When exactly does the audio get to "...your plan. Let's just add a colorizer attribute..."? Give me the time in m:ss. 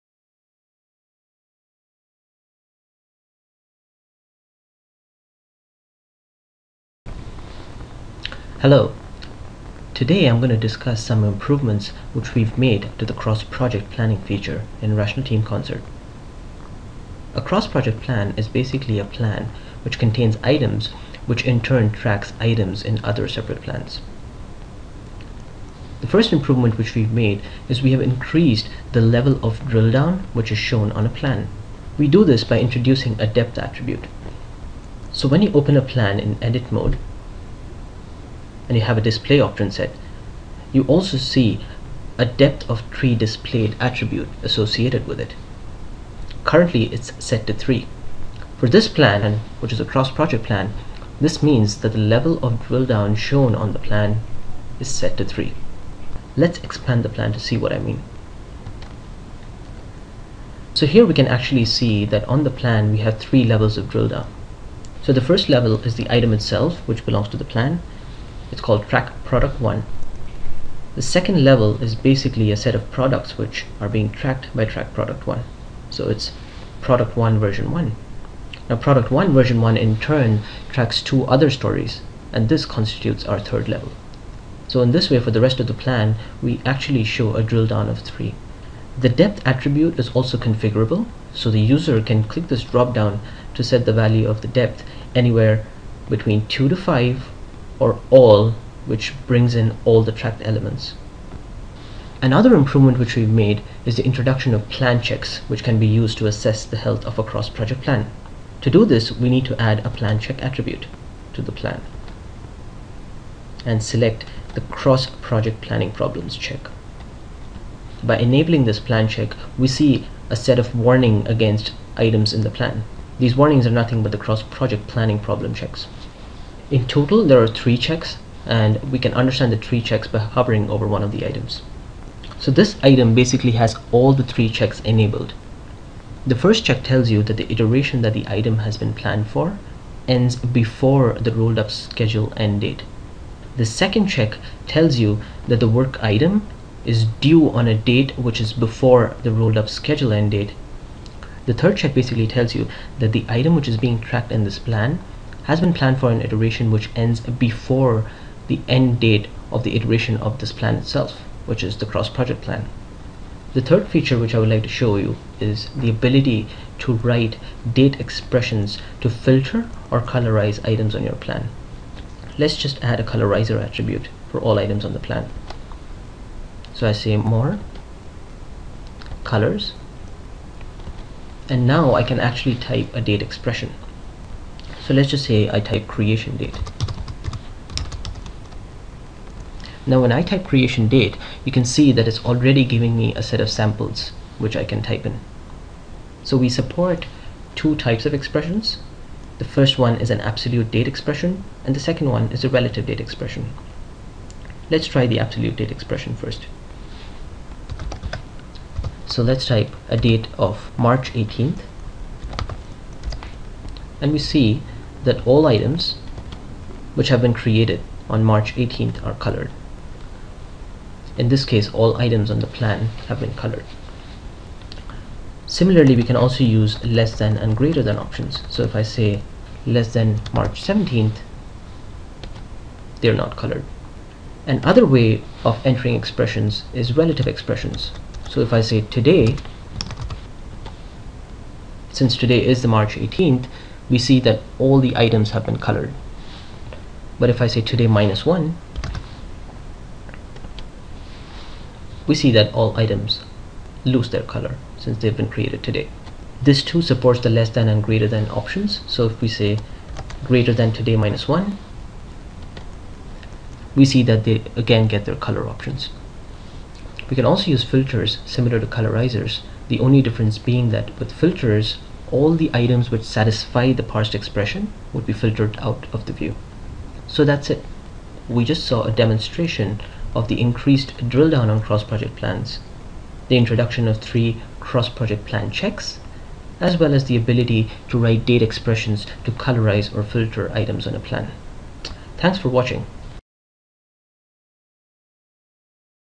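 2:51.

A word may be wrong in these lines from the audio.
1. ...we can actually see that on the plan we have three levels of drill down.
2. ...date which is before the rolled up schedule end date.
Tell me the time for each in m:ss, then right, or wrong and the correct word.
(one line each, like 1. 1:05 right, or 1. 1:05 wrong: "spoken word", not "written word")
1. 1:01 right
2. 2:27 right.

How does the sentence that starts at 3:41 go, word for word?
In this case, all items on the plan have been colored.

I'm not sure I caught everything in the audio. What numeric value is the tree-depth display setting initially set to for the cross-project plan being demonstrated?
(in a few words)
3.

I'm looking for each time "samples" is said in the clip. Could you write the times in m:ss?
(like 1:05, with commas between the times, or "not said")
3:13.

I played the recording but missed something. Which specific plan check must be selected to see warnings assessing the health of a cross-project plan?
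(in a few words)
cross project planning problems.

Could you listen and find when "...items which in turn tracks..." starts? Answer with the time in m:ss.
0:20.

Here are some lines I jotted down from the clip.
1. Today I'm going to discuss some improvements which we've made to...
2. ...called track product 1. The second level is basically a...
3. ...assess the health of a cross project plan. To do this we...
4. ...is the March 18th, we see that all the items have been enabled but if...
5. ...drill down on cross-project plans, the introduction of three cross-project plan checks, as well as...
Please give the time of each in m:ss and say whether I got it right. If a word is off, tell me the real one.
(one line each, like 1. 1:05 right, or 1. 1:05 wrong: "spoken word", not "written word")
1. 0:09 right
2. 1:08 right
3. 1:46 right
4. 4:02 wrong: "colored", not "enabled"
5. 4:41 right.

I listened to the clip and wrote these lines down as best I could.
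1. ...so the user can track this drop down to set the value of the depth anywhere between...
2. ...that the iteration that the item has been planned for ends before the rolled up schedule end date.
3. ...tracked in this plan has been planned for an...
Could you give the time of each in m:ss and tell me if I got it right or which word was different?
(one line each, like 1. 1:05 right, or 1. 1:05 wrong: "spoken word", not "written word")
1. 1:31 wrong: "click", not "track"
2. 2:17 right
3. 2:33 right.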